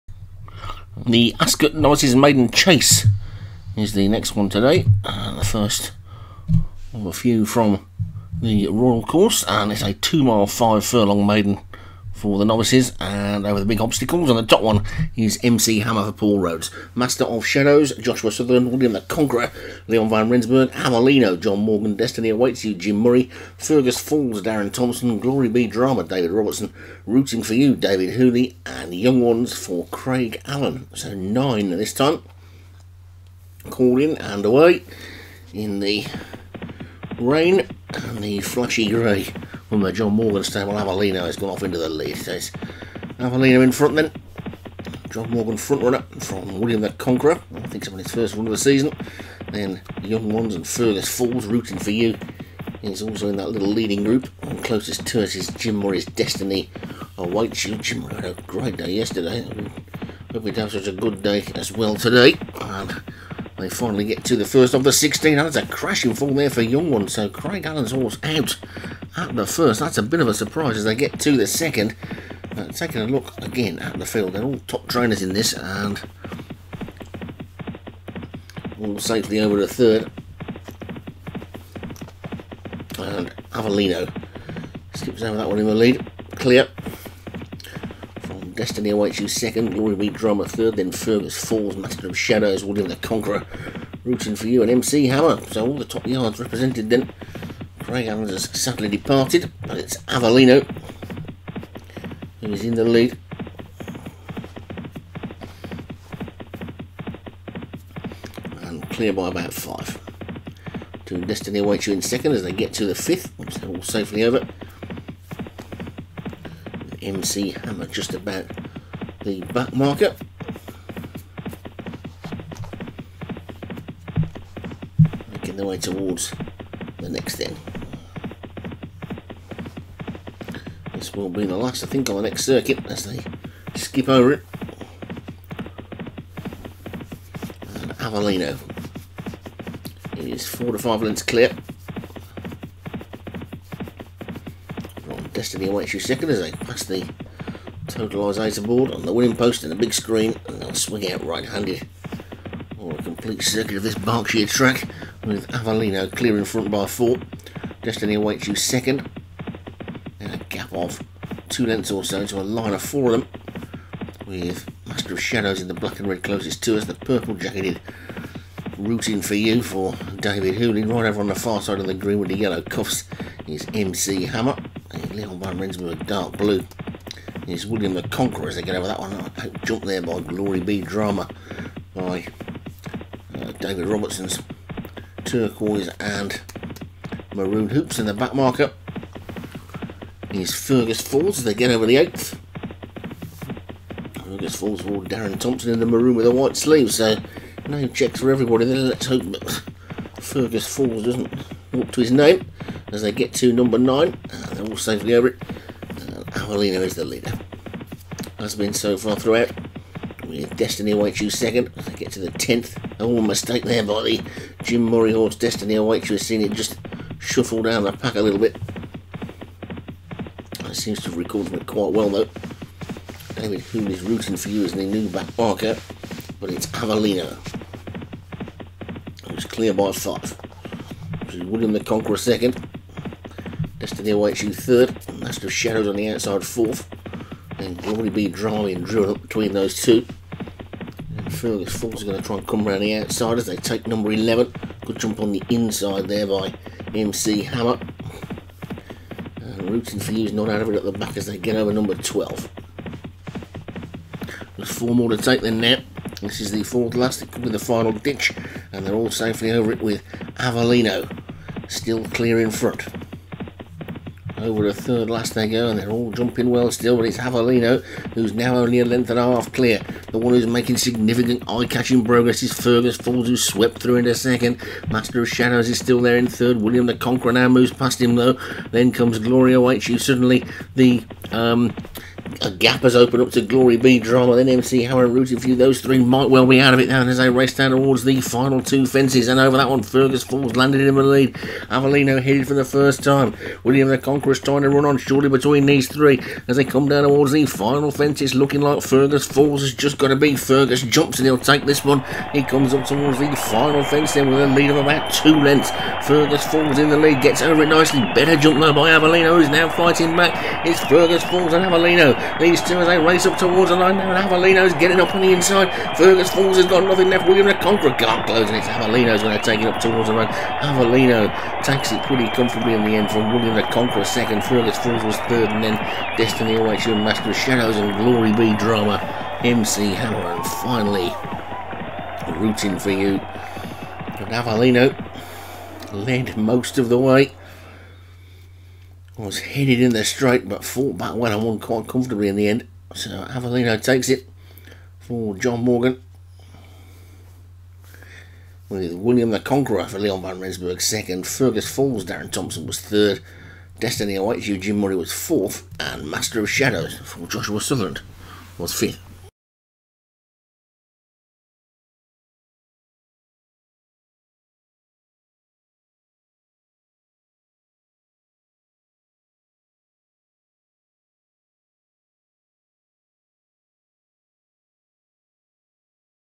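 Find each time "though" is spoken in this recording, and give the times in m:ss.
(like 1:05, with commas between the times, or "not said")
3:42, 4:38.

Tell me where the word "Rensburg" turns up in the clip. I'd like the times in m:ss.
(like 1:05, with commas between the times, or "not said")
0:20, 2:55, 5:50.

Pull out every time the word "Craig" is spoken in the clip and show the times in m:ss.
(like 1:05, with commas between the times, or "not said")
0:29, 1:07, 1:37.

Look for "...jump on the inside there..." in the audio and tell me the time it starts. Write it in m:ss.
4:05.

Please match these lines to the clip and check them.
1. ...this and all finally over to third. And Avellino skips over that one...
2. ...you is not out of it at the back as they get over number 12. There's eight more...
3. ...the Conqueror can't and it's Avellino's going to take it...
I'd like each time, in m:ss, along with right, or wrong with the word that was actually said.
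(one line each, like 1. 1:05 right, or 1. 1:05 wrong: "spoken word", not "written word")
1. 1:15 wrong: "safely", not "finally"
2. 4:10 wrong: "four", not "eight"
3. 5:17 right.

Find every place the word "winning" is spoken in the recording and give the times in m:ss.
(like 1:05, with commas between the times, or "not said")
2:29.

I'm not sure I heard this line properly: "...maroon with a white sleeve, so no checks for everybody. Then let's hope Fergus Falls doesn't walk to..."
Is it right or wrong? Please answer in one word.
right.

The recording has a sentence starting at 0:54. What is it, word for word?
And closest to us is Jim Murray's Destiny awaits oh, you.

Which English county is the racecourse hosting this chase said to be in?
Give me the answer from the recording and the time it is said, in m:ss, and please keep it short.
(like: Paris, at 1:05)
Berkshire, at 2:33.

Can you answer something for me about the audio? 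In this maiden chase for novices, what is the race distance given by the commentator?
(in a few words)
2 miles 5 furlongs.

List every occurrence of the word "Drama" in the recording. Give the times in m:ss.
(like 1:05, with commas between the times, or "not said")
0:25, 1:30, 3:00, 3:58, 4:43, 5:28.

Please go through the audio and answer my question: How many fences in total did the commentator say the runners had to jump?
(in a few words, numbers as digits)
16.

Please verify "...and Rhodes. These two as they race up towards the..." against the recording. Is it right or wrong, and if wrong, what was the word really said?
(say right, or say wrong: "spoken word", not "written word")
wrong: "Avellino", not "Rhodes".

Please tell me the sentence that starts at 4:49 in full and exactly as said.
And over that one, Fergus Falls landed in the lead.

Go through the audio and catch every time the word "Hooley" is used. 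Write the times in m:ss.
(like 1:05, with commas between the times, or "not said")
0:28, 2:50.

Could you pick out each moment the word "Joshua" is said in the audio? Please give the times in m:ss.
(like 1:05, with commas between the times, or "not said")
0:17, 5:57.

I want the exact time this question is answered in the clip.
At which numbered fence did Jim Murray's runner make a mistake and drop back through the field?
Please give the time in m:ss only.
3:32.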